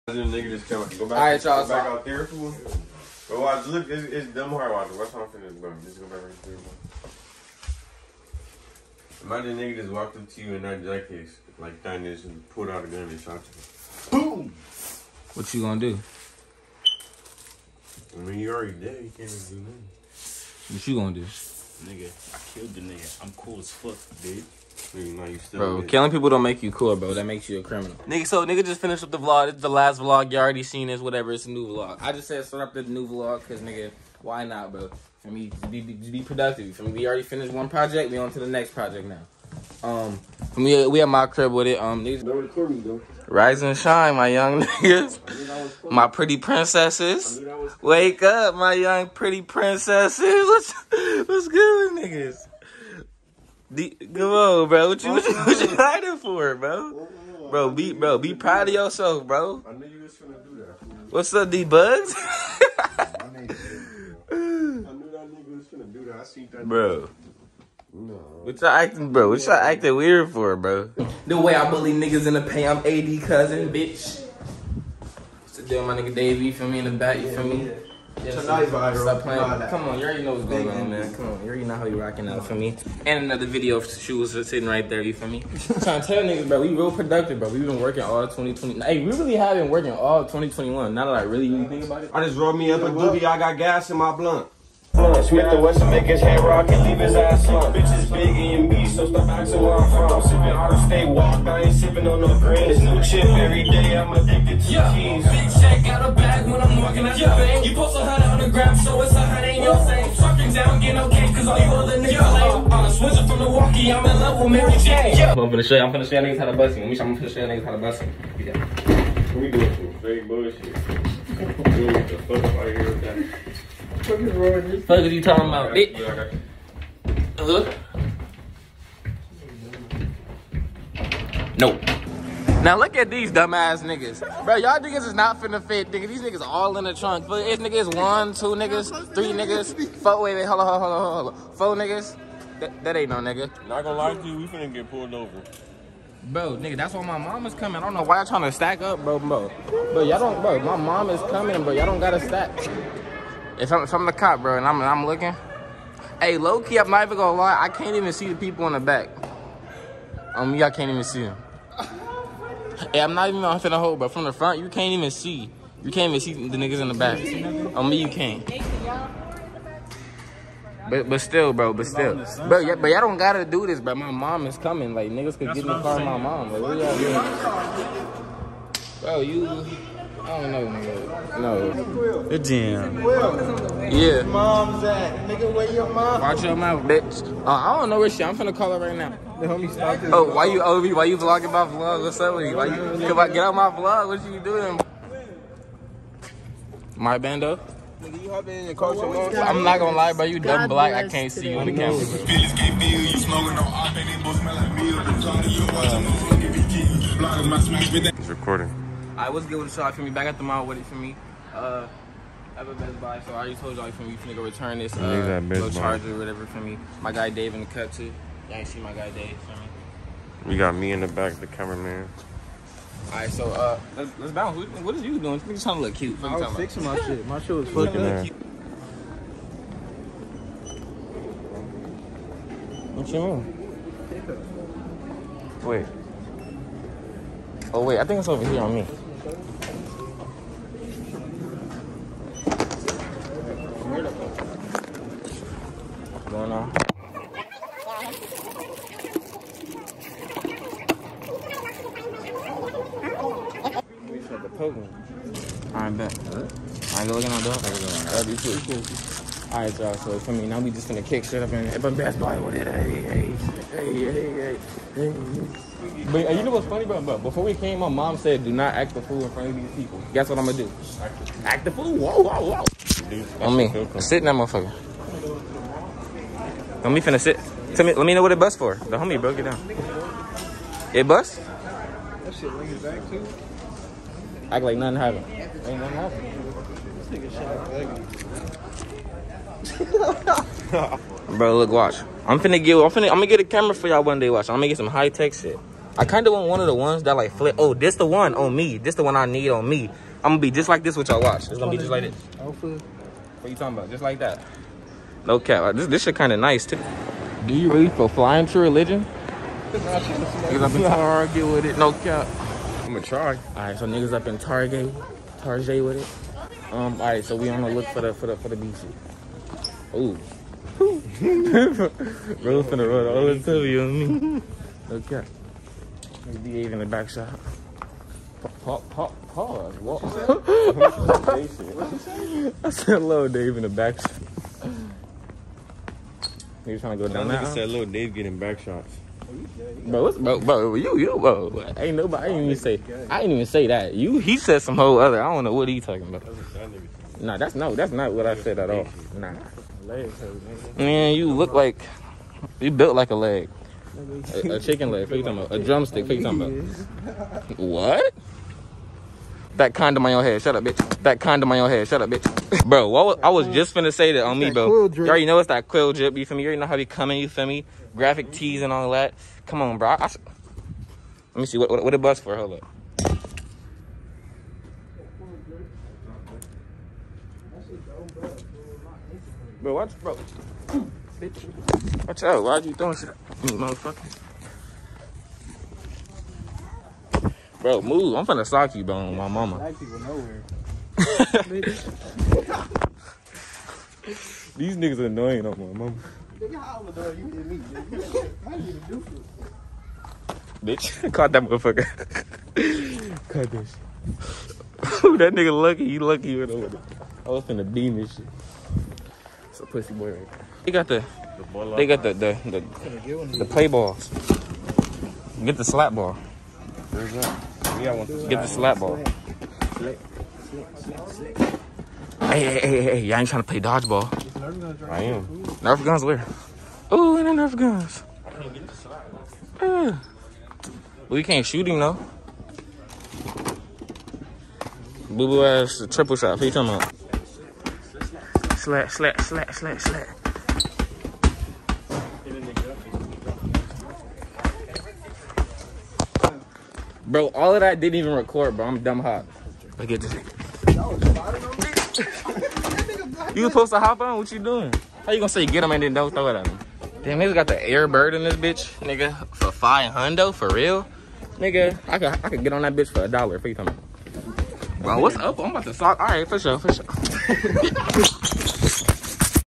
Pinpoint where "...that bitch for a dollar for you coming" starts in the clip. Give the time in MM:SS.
07:42.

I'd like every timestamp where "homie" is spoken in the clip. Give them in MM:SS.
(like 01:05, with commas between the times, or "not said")
03:09, 04:38.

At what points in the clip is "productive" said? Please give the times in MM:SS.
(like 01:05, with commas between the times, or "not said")
00:36, 01:26.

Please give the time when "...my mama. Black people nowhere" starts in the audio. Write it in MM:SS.
06:29.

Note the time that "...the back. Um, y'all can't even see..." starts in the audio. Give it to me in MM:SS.
02:38.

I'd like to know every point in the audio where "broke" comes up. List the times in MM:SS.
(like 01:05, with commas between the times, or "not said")
04:39.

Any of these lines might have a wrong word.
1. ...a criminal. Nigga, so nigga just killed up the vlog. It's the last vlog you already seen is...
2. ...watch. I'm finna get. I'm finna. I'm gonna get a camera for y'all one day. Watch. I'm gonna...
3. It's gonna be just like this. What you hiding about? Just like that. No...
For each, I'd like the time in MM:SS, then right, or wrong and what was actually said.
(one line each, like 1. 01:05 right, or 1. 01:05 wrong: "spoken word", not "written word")
1. 00:27 wrong: "finished", not "killed"
2. 04:51 right
3. 05:01 wrong: "talking", not "hiding".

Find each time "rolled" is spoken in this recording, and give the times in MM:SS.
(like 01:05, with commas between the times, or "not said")
01:32.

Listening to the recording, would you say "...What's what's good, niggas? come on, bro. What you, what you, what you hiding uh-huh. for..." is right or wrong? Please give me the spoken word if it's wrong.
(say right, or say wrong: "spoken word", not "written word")
right.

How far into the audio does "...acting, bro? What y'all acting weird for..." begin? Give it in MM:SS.
01:08.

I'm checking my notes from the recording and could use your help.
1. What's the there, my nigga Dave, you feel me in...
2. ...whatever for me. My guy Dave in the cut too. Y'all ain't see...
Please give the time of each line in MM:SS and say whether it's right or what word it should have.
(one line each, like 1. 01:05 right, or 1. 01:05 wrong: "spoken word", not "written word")
1. 01:15 right
2. 03:36 right.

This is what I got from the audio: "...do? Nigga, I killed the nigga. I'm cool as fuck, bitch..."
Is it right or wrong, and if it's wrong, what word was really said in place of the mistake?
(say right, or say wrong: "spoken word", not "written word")
right.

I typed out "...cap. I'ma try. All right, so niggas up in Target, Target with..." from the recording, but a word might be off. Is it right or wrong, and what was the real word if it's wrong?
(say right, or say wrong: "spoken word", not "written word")
right.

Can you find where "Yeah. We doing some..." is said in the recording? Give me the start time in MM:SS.
01:58.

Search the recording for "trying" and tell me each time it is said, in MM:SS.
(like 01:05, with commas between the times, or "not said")
01:25, 02:28, 03:45, 05:36, 07:03.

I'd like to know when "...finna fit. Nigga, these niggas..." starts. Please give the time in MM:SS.
02:15.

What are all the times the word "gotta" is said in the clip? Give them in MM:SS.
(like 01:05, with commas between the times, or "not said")
02:31, 02:53.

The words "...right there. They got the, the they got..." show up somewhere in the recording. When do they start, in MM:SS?
06:50.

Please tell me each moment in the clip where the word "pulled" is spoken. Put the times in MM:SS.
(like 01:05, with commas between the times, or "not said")
00:12, 02:24.